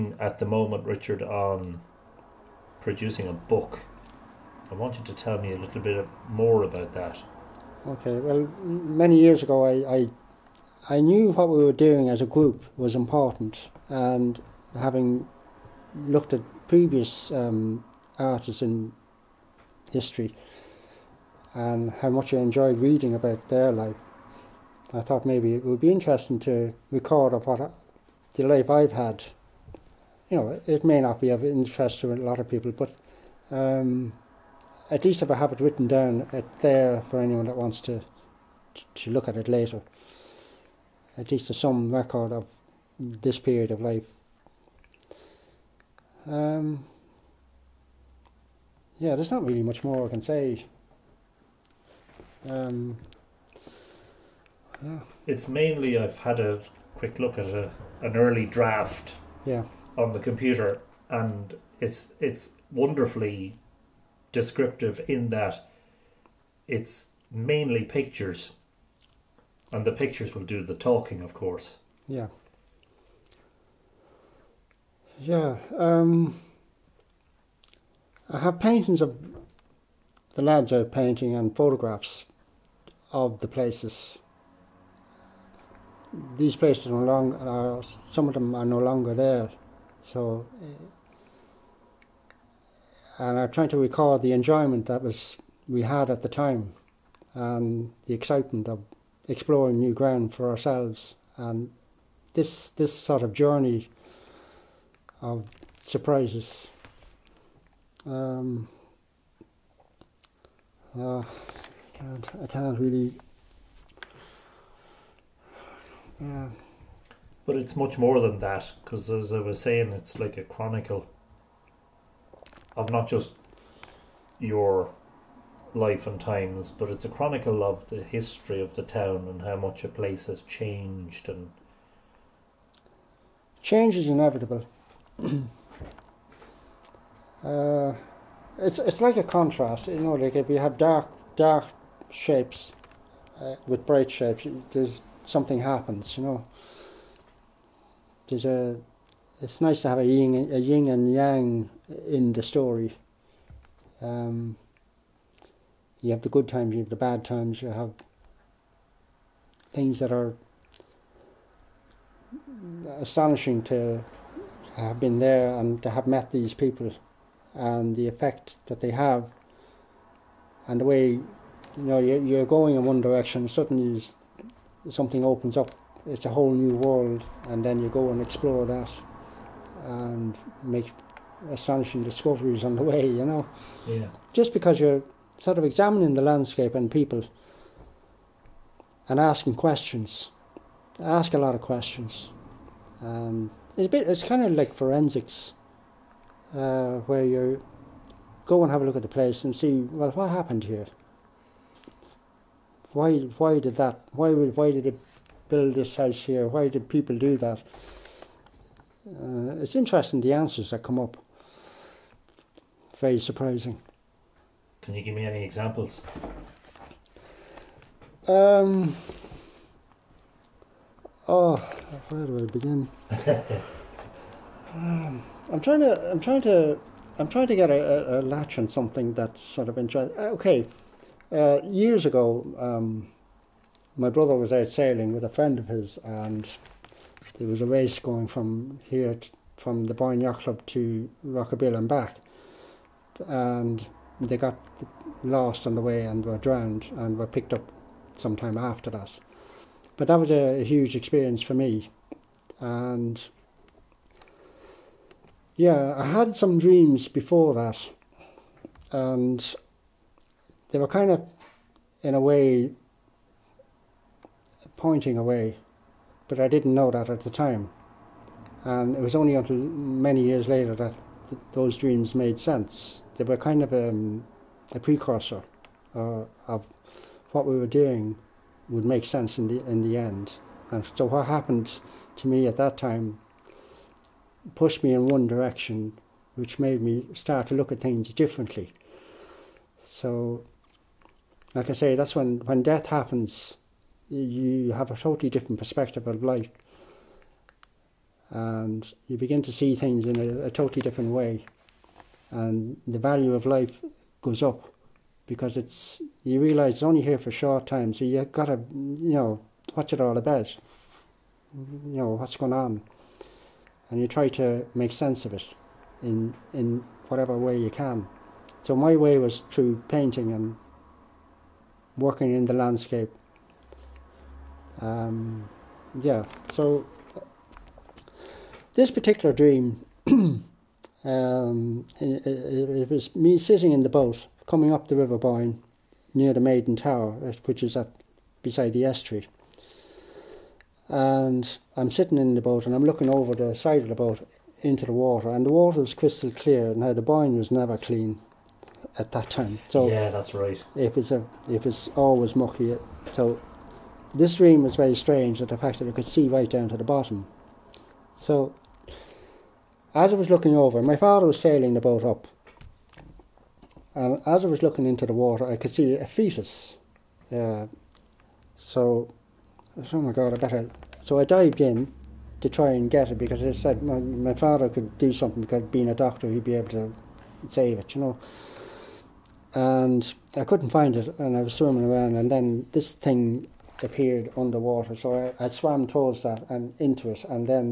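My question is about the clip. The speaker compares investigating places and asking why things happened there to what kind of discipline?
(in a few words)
Forensics.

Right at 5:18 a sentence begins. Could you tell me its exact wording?
So my way was through painting and working in the landscape.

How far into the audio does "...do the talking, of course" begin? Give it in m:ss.
1:10.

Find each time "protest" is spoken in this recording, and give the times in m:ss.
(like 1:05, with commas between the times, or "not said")
not said.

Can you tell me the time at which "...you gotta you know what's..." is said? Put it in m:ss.
5:08.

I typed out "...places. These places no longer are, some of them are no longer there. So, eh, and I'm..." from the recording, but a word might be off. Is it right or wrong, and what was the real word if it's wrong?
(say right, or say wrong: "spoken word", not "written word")
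right.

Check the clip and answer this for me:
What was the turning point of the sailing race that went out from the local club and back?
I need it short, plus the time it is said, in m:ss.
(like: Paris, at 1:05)
Rockabill, at 4:01.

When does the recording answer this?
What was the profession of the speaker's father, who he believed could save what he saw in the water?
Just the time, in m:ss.
6:15.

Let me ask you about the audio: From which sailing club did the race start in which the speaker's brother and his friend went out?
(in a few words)
Boyne Yacht Club.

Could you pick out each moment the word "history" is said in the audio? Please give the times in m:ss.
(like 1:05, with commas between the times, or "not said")
0:19, 2:08.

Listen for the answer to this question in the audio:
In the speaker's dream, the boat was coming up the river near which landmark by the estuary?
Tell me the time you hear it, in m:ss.
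5:36.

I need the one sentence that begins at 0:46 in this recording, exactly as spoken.
Um, yeah, there's not really much more I can say.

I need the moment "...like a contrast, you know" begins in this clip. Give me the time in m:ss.
2:19.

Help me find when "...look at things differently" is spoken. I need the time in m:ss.
4:47.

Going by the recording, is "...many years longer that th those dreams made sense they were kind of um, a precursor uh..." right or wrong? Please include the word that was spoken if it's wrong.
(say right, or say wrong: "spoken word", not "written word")
wrong: "later", not "longer".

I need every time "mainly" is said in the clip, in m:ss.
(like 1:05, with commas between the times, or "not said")
0:55, 1:07.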